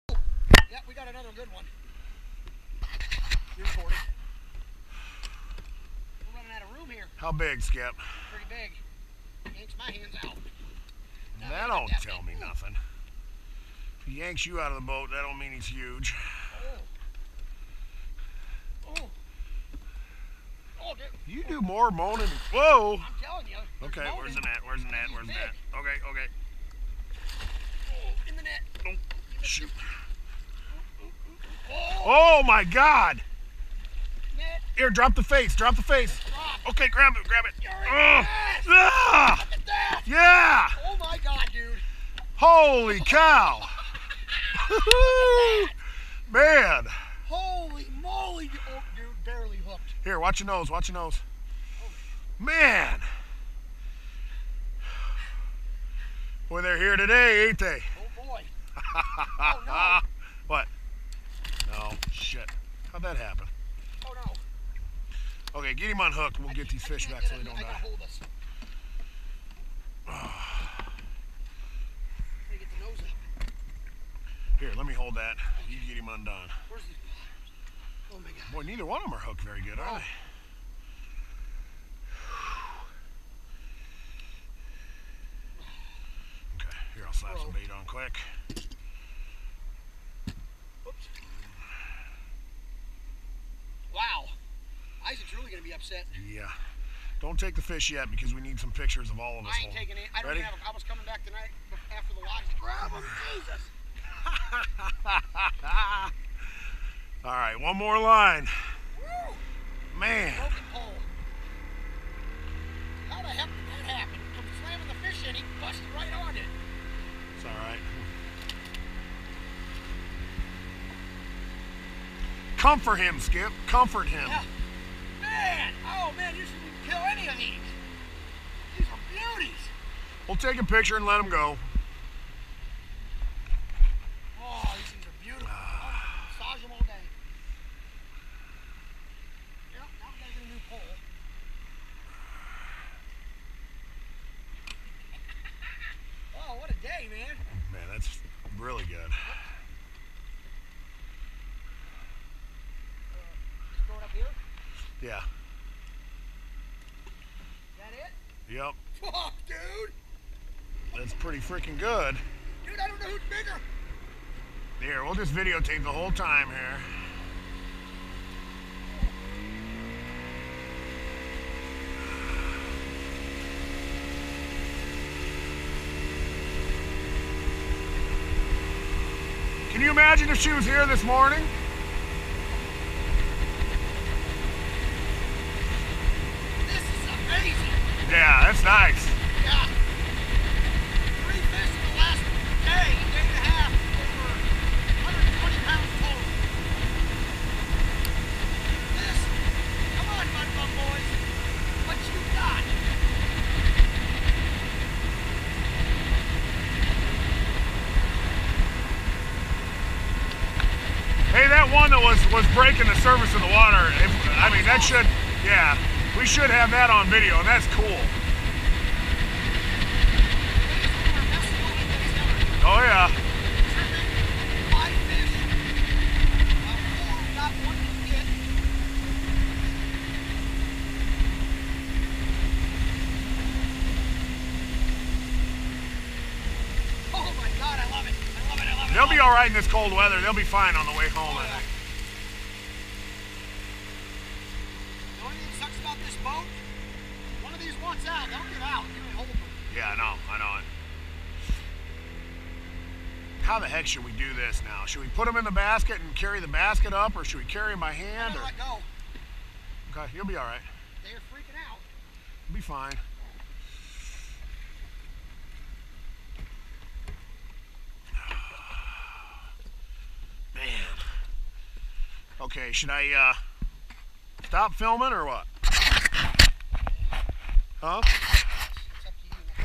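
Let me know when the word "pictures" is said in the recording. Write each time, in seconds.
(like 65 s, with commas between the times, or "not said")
98 s, 130 s.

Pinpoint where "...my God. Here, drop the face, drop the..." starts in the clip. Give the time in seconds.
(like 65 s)
32 s.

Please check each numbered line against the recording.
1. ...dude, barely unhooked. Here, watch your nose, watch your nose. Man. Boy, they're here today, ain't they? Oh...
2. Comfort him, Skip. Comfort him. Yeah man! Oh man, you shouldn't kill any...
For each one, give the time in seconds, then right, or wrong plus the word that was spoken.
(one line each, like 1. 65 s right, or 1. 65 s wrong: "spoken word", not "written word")
1. 48 s wrong: "hooked", not "unhooked"
2. 122 s right.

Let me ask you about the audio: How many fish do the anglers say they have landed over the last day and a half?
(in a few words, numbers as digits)
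3.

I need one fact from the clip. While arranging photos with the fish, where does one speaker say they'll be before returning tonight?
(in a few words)
The lodge.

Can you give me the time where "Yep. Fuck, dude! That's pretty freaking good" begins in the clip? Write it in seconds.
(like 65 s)
158 s.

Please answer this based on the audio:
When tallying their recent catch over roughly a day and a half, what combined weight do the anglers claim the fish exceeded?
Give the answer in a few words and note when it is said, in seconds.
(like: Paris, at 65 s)
120 pounds, at 195 s.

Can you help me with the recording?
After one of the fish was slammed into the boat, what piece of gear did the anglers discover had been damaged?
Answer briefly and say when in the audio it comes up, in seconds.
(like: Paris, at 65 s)
Broken pole, at 110 s.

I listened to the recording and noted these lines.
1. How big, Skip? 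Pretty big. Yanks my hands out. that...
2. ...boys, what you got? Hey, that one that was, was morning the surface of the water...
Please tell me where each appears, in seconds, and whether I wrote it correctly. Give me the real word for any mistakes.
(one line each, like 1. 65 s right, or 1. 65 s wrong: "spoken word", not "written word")
1. 7 s right
2. 200 s wrong: "breaking", not "morning".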